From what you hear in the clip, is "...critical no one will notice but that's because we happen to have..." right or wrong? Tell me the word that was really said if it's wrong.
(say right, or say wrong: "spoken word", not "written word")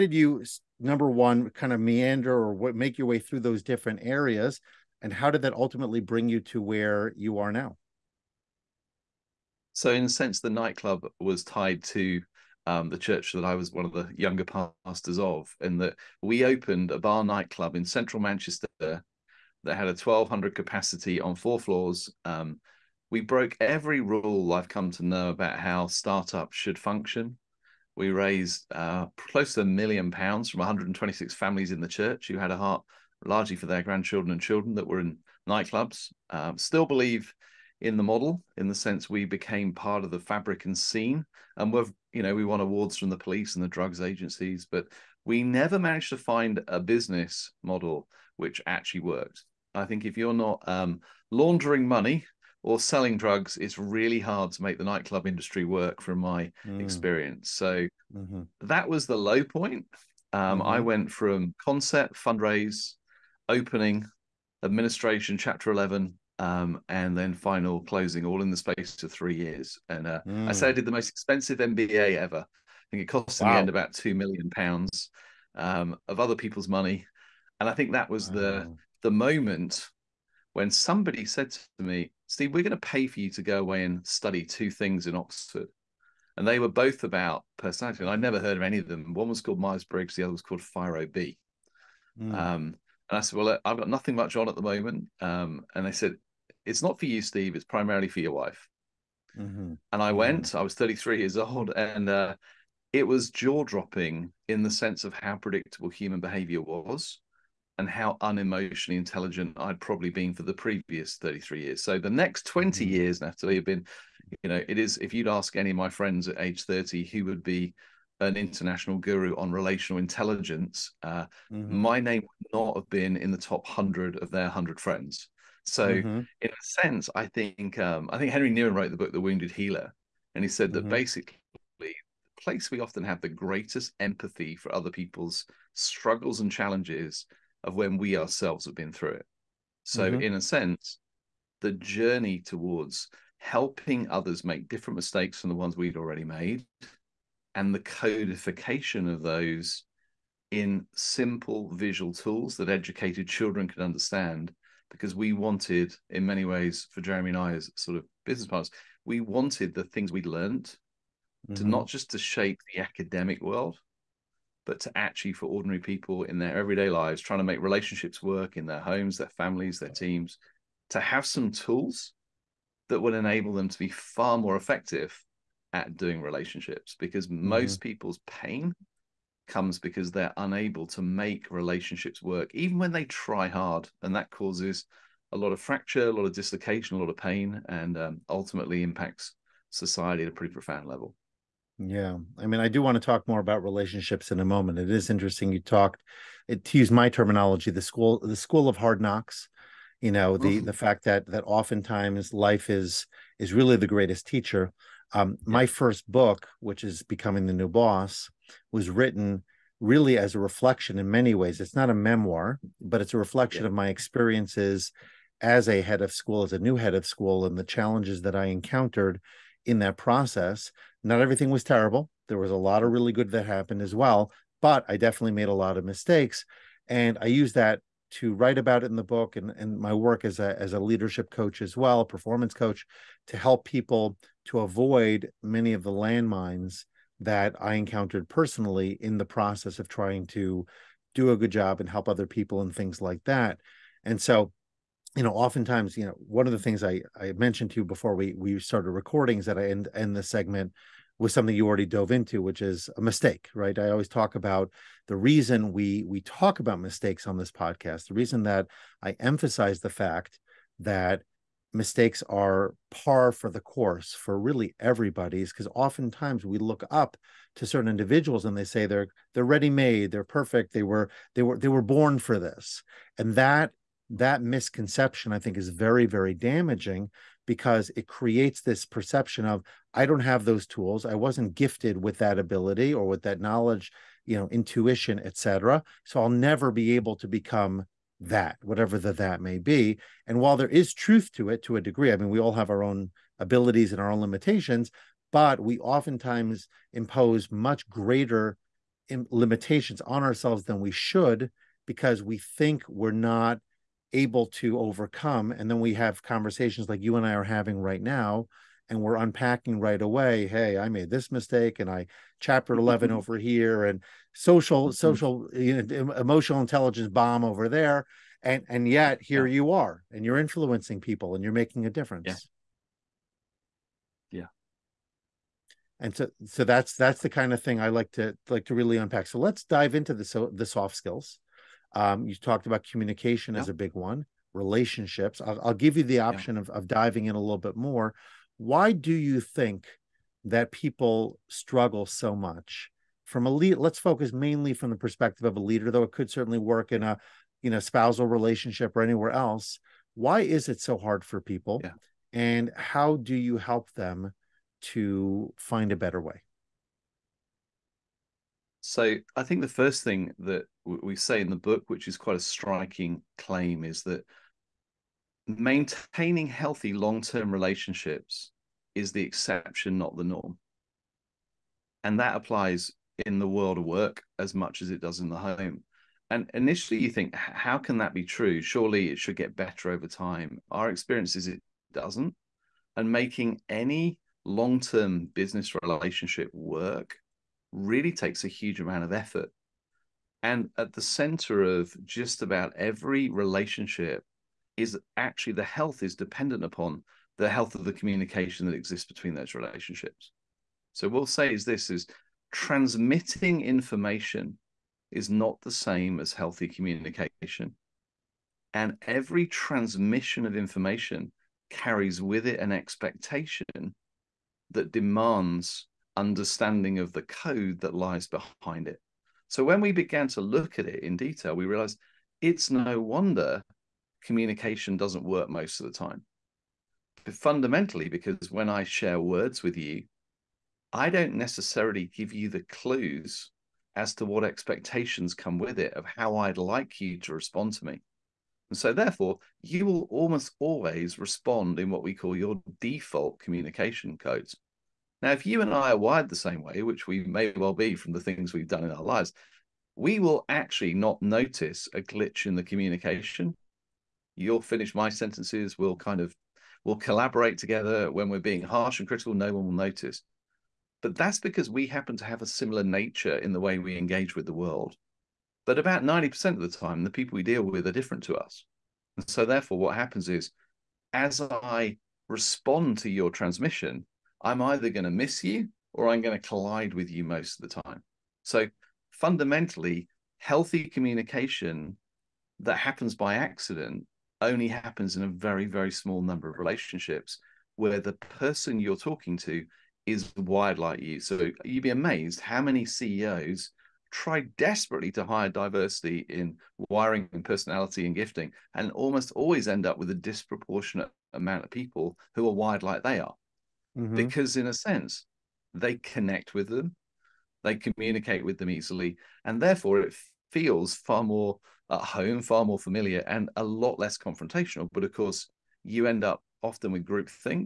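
right.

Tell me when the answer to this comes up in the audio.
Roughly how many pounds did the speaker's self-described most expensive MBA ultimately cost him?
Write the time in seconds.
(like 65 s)
73 s.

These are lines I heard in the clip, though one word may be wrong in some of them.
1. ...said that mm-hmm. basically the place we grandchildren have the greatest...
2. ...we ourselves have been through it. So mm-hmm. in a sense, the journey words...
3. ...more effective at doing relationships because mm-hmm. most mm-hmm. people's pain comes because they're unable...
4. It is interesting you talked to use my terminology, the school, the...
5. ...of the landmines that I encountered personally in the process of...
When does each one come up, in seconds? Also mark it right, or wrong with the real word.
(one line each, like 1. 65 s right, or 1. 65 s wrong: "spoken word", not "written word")
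1. 130 s wrong: "often", not "grandchildren"
2. 137 s wrong: "towards", not "words"
3. 174 s right
4. 194 s right
5. 235 s right.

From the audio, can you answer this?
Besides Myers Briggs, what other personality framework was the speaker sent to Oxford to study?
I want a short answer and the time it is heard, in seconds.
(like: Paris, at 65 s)
FIRO-B, at 90 s.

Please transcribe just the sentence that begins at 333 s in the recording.
as a big one relationships i'll, I'll give you the option yep.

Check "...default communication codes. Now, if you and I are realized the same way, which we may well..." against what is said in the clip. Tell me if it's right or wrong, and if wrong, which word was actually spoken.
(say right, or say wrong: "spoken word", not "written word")
wrong: "wired", not "realized".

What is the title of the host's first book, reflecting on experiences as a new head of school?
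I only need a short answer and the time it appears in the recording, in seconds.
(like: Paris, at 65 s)
Becoming the New Boss, at 207 s.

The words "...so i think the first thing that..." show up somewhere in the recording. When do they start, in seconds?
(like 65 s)
358 s.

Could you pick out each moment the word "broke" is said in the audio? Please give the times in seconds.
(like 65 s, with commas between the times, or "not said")
23 s.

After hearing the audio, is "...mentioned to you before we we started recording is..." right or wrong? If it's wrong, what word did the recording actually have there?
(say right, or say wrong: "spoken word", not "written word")
right.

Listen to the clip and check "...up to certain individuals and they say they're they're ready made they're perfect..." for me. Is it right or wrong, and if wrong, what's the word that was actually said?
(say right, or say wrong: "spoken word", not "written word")
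right.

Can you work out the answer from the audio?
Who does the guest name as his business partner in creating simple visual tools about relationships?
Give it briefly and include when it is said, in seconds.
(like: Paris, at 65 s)
Jeremy, at 157 s.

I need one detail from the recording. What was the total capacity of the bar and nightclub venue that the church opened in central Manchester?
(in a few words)
1200.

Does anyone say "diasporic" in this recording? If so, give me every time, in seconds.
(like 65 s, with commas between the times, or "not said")
not said.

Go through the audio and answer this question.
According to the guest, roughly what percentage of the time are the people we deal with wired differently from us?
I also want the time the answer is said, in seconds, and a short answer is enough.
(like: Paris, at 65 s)
90%, at 466 s.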